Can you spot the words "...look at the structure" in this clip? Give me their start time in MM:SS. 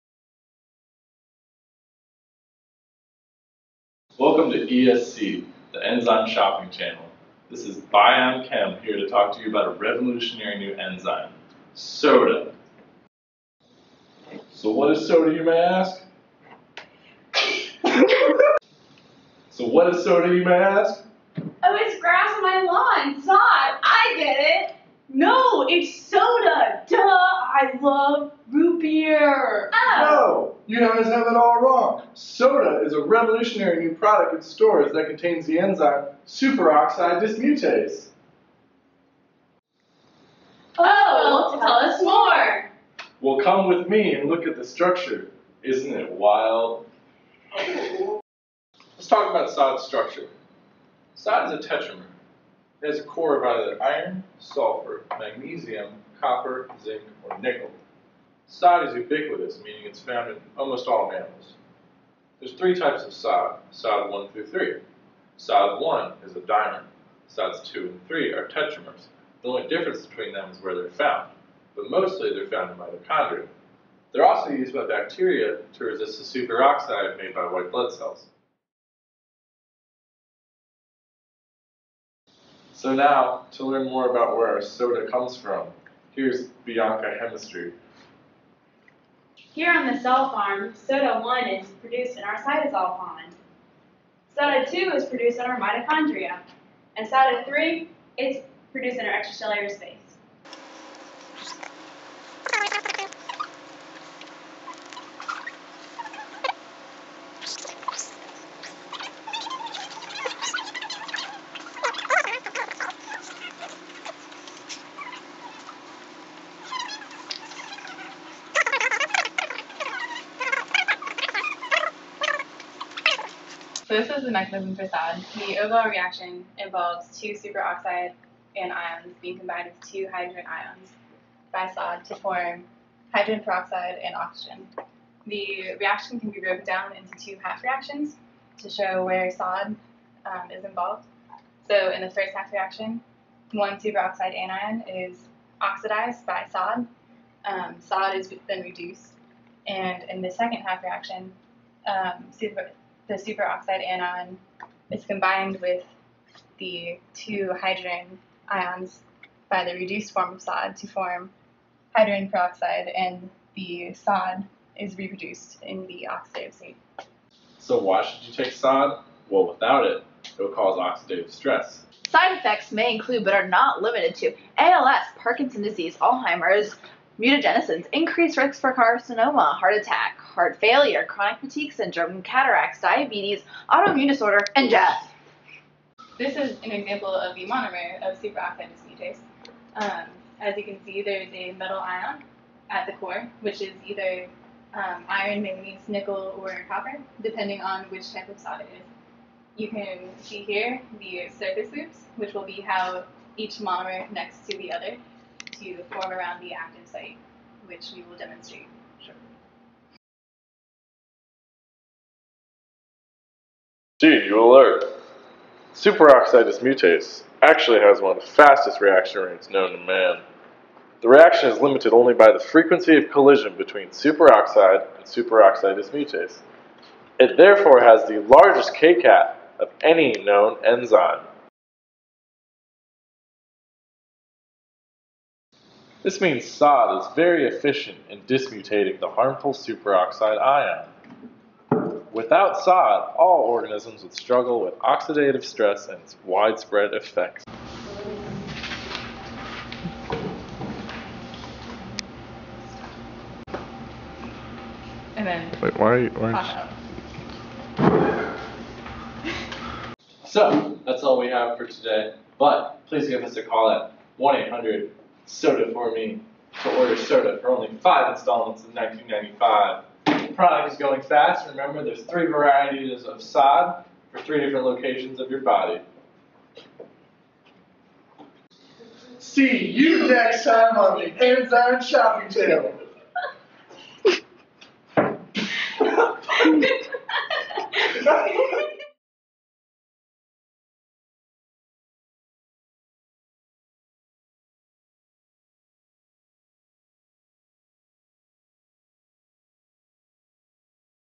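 00:44.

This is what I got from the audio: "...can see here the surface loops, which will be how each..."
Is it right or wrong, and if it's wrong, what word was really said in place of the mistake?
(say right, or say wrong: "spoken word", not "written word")
right.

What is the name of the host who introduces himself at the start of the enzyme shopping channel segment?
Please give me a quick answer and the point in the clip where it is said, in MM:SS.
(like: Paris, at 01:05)
Bion Chem, at 00:07.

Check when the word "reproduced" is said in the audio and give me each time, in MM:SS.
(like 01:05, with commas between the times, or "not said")
02:44.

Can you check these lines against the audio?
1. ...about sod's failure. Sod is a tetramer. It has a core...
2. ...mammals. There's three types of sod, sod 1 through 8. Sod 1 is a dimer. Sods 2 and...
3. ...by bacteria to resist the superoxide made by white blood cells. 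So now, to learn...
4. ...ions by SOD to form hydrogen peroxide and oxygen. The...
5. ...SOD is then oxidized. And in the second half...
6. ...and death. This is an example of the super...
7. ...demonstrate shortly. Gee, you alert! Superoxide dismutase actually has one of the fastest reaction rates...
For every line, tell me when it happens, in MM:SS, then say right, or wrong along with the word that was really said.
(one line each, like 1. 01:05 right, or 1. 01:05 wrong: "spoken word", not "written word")
1. 00:49 wrong: "structure", not "failure"
2. 01:01 wrong: "3", not "8"
3. 01:14 right
4. 02:10 right
5. 02:27 wrong: "reduced", not "oxidized"
6. 03:04 wrong: "monomer", not "super"
7. 03:28 right.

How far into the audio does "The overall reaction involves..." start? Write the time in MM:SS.
02:05.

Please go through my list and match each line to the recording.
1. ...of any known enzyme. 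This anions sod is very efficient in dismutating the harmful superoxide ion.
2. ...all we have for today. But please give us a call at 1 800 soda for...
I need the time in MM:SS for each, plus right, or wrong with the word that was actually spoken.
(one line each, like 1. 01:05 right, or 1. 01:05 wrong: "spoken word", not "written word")
1. 03:49 wrong: "means", not "anions"
2. 04:21 right.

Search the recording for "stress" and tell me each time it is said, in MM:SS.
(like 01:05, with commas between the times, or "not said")
02:51, 04:05.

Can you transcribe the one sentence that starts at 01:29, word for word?
Here on the cell farm, soda 1 is produced in our cytosol pond.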